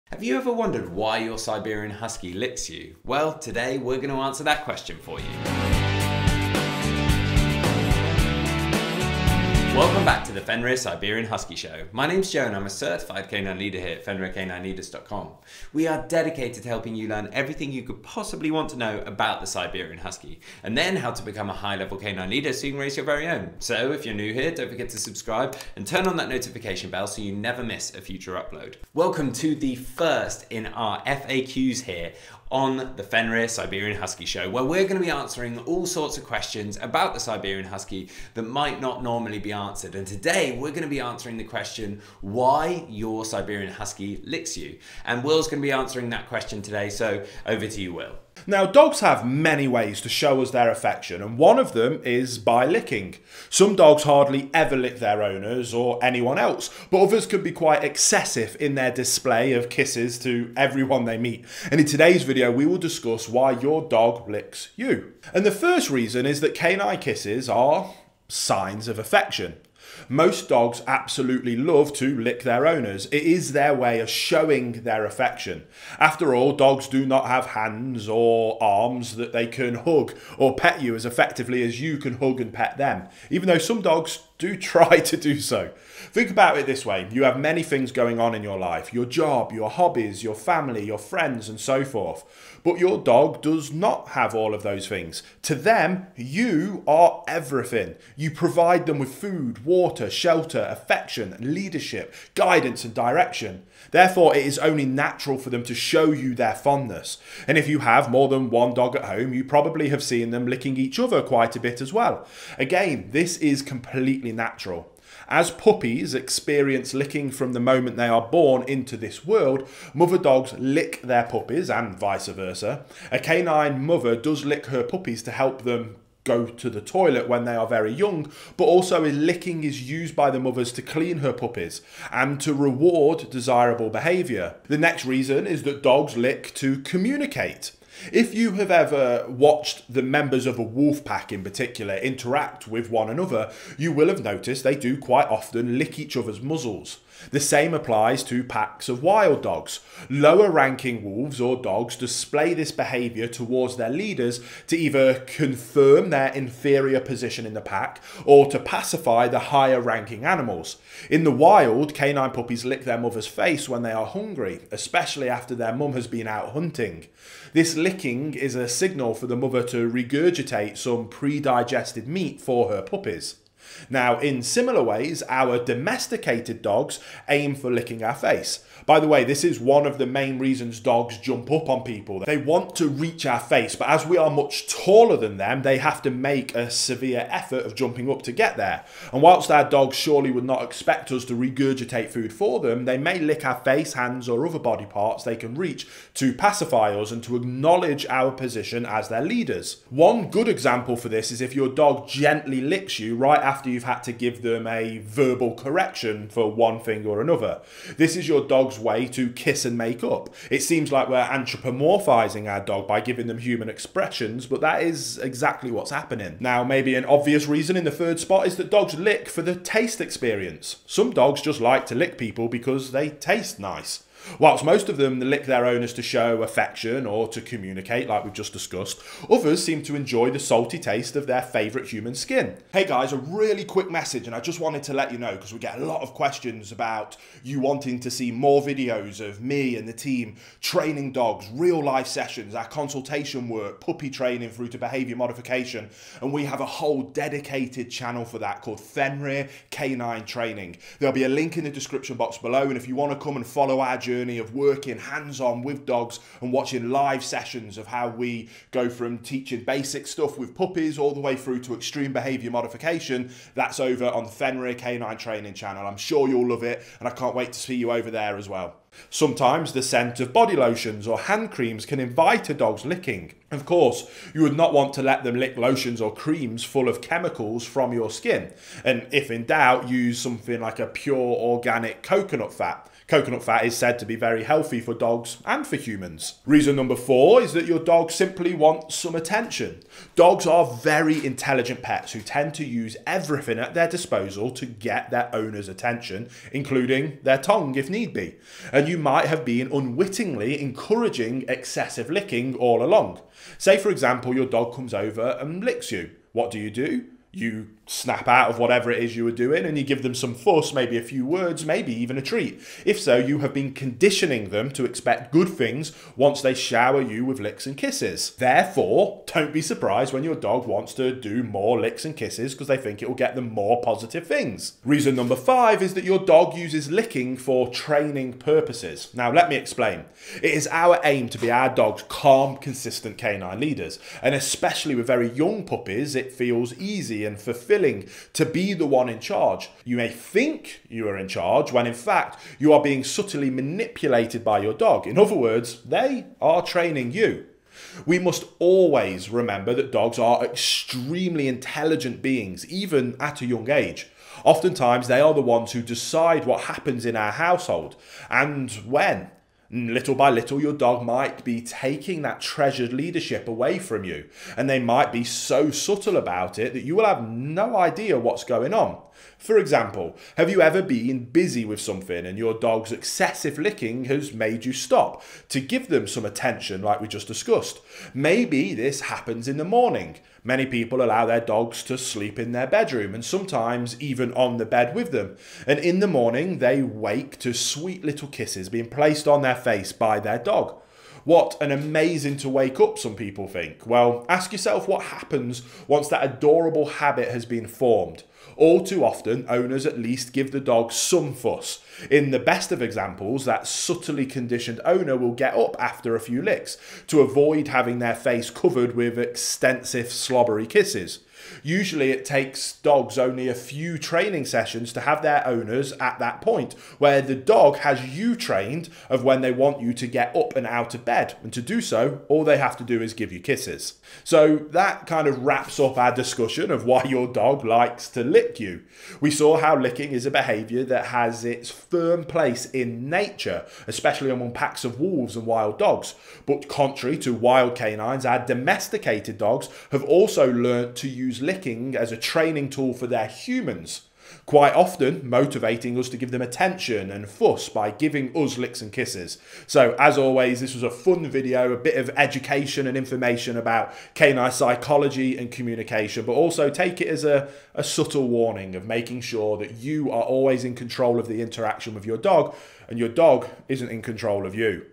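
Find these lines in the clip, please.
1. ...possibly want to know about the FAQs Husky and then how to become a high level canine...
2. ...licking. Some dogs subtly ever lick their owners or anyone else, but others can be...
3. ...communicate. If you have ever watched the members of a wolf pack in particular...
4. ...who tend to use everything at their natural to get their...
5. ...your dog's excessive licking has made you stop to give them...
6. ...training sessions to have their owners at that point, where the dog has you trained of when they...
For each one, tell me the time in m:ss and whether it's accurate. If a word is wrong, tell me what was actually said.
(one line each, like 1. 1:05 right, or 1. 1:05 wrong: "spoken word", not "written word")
1. 0:18 wrong: "Siberian", not "FAQs"
2. 0:52 wrong: "hardly", not "subtly"
3. 2:16 right
4. 4:52 wrong: "disposal", not "natural"
5. 6:12 right
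6. 6:53 right.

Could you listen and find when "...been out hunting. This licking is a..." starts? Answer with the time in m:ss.
2:46.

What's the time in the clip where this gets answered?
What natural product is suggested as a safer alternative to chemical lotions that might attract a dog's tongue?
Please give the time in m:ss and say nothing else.
4:40.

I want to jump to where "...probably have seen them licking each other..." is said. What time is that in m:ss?
1:49.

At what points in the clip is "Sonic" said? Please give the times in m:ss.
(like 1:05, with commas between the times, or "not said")
not said.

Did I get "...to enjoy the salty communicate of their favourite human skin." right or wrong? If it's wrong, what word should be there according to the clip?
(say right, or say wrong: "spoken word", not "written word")
wrong: "taste", not "communicate".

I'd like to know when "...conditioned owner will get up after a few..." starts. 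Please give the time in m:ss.
6:44.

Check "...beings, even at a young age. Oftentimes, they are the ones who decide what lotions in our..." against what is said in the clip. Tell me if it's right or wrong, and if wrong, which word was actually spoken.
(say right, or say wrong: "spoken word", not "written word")
wrong: "happens", not "lotions".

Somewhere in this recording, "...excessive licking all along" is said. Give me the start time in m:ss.
5:01.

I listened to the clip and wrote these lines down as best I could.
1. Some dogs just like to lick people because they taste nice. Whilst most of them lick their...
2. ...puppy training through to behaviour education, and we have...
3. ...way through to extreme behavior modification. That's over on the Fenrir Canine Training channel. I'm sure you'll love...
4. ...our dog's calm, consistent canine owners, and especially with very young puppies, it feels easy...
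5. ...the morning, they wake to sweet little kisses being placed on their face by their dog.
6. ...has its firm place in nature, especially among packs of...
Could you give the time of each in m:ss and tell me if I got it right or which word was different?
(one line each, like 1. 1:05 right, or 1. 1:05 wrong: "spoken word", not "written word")
1. 3:40 right
2. 4:03 wrong: "modification", not "education"
3. 4:21 right
4. 5:31 wrong: "leaders", not "owners"
5. 6:25 right
6. 7:11 right.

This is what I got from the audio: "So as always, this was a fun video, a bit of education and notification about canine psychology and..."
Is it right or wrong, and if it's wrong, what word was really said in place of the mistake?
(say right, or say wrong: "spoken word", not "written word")
wrong: "information", not "notification".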